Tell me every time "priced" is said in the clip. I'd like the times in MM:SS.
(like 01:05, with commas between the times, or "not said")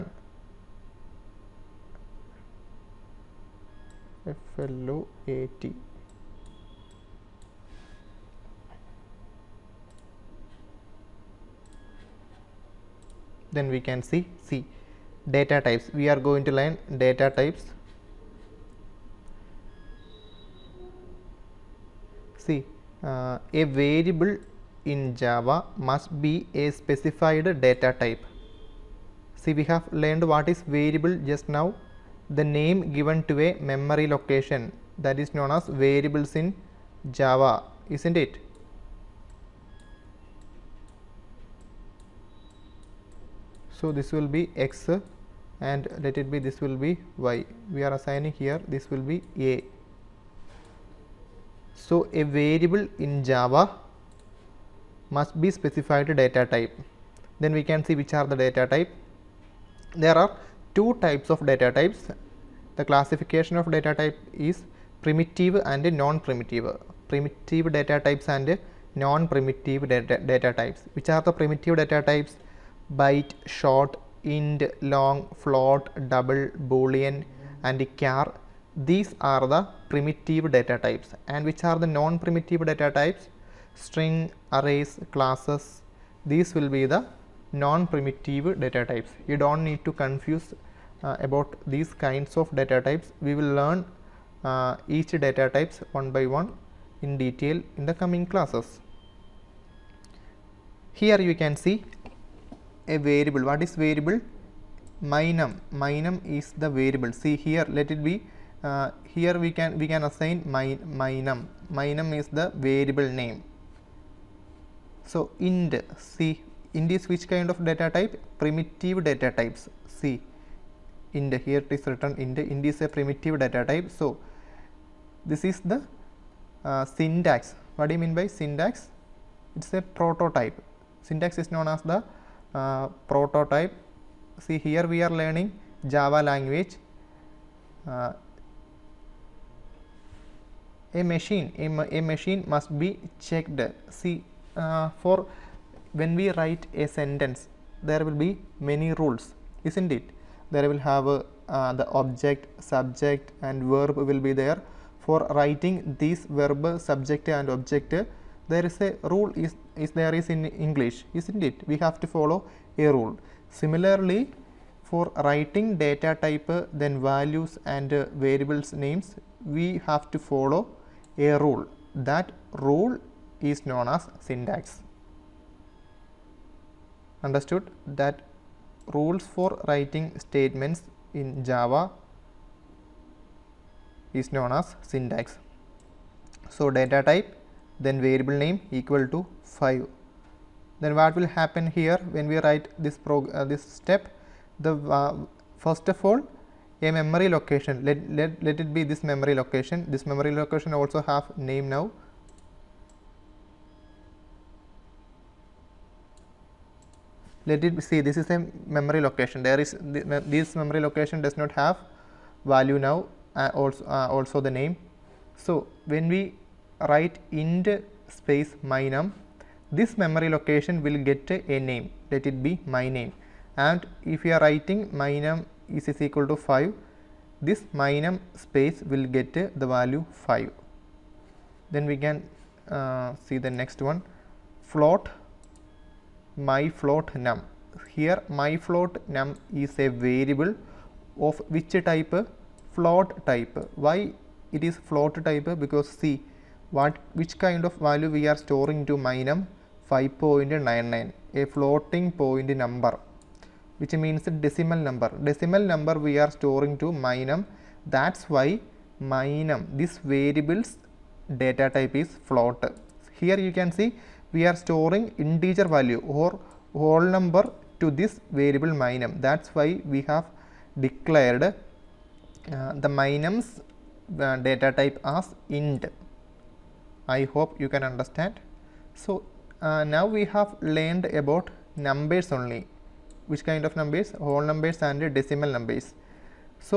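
not said.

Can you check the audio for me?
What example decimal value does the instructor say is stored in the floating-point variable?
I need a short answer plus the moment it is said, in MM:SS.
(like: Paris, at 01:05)
5.99, at 04:09.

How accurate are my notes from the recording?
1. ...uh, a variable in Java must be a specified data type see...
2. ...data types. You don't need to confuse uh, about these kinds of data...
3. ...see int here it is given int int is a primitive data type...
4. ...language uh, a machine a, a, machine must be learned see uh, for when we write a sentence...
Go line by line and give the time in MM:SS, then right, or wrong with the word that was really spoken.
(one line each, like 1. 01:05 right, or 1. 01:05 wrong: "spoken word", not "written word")
1. 00:23 right
2. 01:28 right
3. 01:59 wrong: "written", not "given"
4. 02:16 wrong: "checked", not "learned".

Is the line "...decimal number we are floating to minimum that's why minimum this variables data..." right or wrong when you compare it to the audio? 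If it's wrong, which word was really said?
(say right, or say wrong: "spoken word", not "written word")
wrong: "storing", not "floating".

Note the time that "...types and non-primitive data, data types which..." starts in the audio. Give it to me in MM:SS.
01:08.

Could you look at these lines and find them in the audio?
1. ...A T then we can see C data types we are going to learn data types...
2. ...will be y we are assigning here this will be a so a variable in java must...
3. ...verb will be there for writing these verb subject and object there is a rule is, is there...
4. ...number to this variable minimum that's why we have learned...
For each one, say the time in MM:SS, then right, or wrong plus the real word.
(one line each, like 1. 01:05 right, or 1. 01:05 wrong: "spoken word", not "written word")
1. 00:05 right
2. 00:46 right
3. 02:33 right
4. 04:27 wrong: "declared", not "learned".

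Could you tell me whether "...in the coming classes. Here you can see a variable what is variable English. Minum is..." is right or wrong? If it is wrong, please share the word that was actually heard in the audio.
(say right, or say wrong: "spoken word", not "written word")
wrong: "Minum", not "English".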